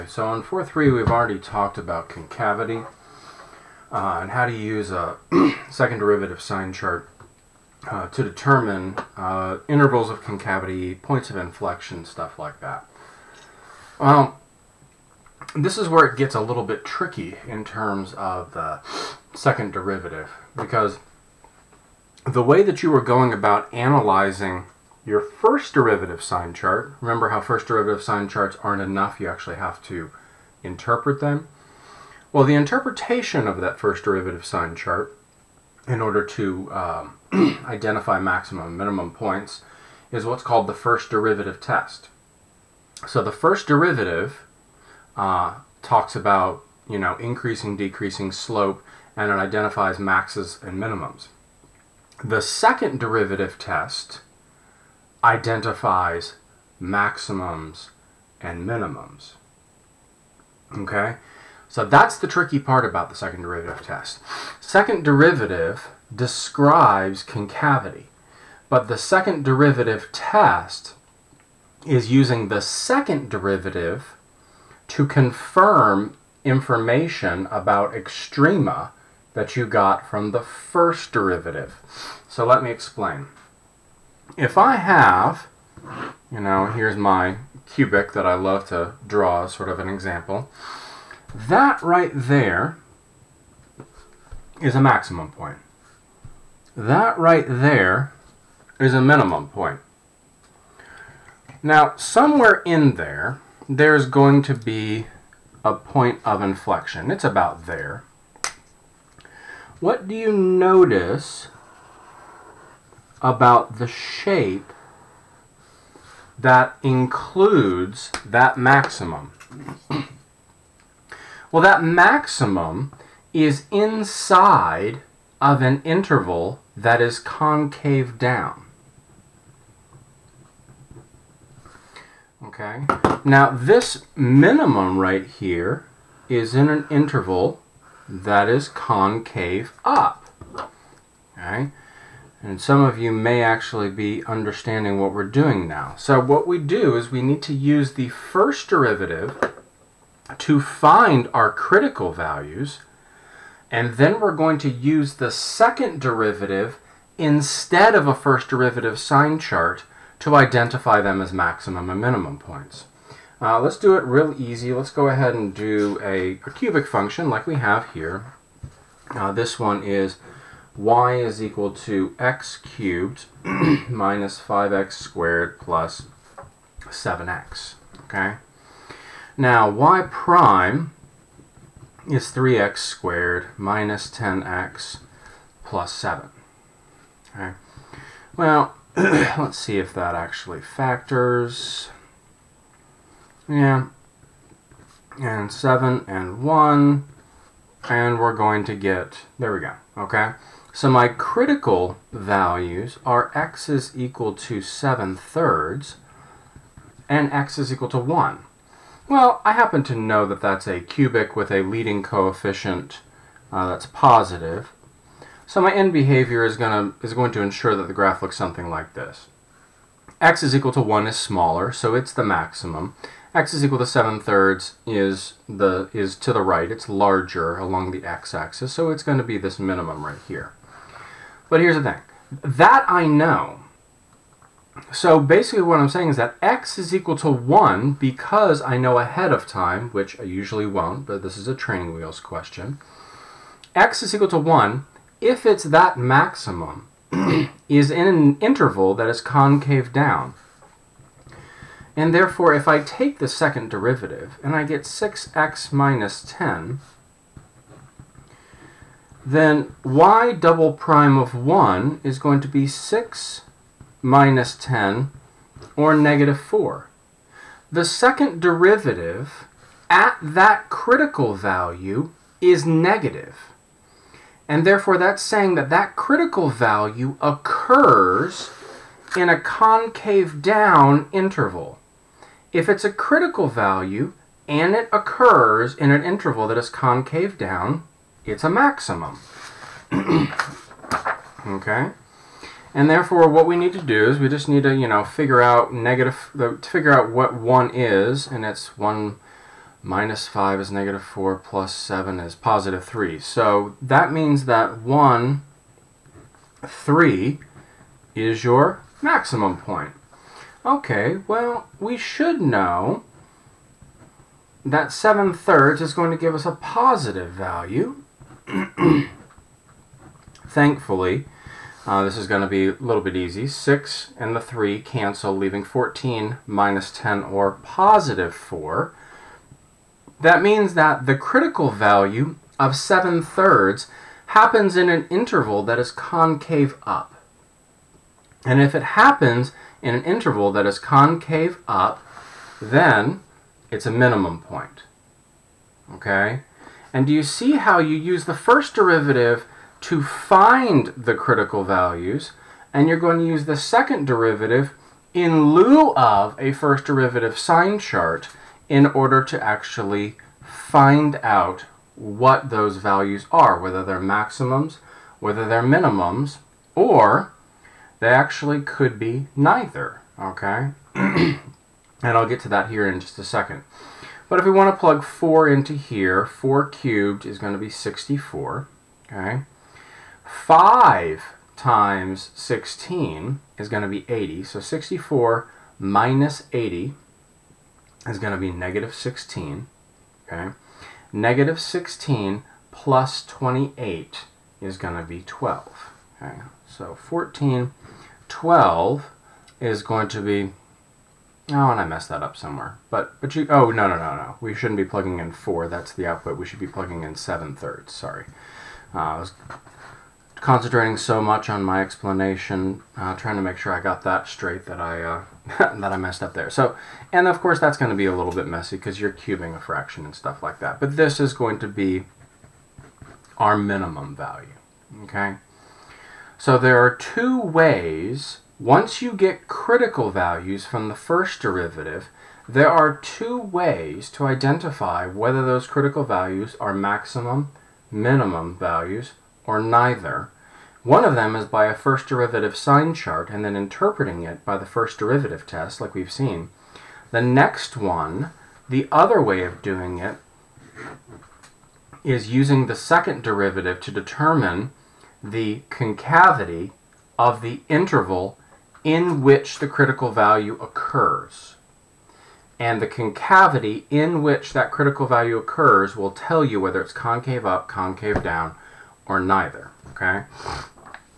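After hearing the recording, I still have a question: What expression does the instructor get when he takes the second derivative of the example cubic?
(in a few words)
6x - 10.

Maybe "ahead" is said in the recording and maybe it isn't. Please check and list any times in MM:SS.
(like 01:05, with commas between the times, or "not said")
02:45, 03:58.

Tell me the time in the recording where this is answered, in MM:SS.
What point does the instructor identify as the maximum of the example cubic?
05:04.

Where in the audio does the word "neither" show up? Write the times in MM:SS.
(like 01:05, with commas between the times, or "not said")
06:09, 07:19, 07:49.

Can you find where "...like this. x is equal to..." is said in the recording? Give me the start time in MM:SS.
03:38.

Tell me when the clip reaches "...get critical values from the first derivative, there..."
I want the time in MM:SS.
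07:09.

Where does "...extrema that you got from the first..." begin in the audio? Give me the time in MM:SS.
01:17.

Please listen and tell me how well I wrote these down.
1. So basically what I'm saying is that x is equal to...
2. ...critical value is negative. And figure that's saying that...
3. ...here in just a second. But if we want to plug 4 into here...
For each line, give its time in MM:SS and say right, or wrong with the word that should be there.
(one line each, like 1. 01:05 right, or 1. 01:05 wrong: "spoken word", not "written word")
1. 03:54 right
2. 04:30 wrong: "therefore", not "figure"
3. 06:12 right.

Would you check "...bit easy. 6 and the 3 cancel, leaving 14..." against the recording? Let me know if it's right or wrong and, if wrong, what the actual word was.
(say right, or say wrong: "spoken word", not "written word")
right.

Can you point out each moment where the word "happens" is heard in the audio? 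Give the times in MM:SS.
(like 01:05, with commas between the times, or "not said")
03:29, 05:34, 05:38.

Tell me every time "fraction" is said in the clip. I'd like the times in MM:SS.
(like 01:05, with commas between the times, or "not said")
06:59.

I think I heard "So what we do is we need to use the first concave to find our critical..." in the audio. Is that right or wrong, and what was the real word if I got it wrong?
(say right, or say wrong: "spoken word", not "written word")
wrong: "derivative", not "concave".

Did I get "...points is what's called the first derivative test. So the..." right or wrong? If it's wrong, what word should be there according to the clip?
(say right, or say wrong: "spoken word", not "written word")
right.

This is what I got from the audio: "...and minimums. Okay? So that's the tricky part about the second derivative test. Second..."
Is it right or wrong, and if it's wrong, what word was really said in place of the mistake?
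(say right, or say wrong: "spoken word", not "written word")
right.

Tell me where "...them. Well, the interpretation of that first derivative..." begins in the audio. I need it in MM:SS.
00:31.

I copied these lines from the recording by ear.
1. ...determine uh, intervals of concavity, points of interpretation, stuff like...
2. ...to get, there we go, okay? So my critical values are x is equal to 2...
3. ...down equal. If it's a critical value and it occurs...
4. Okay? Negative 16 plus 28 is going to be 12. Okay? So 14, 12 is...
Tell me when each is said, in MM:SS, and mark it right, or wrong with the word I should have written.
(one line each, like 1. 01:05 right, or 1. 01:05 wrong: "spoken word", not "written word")
1. 00:08 wrong: "inflection", not "interpretation"
2. 03:18 wrong: "7", not "2"
3. 04:40 wrong: "interval", not "equal"
4. 06:30 right.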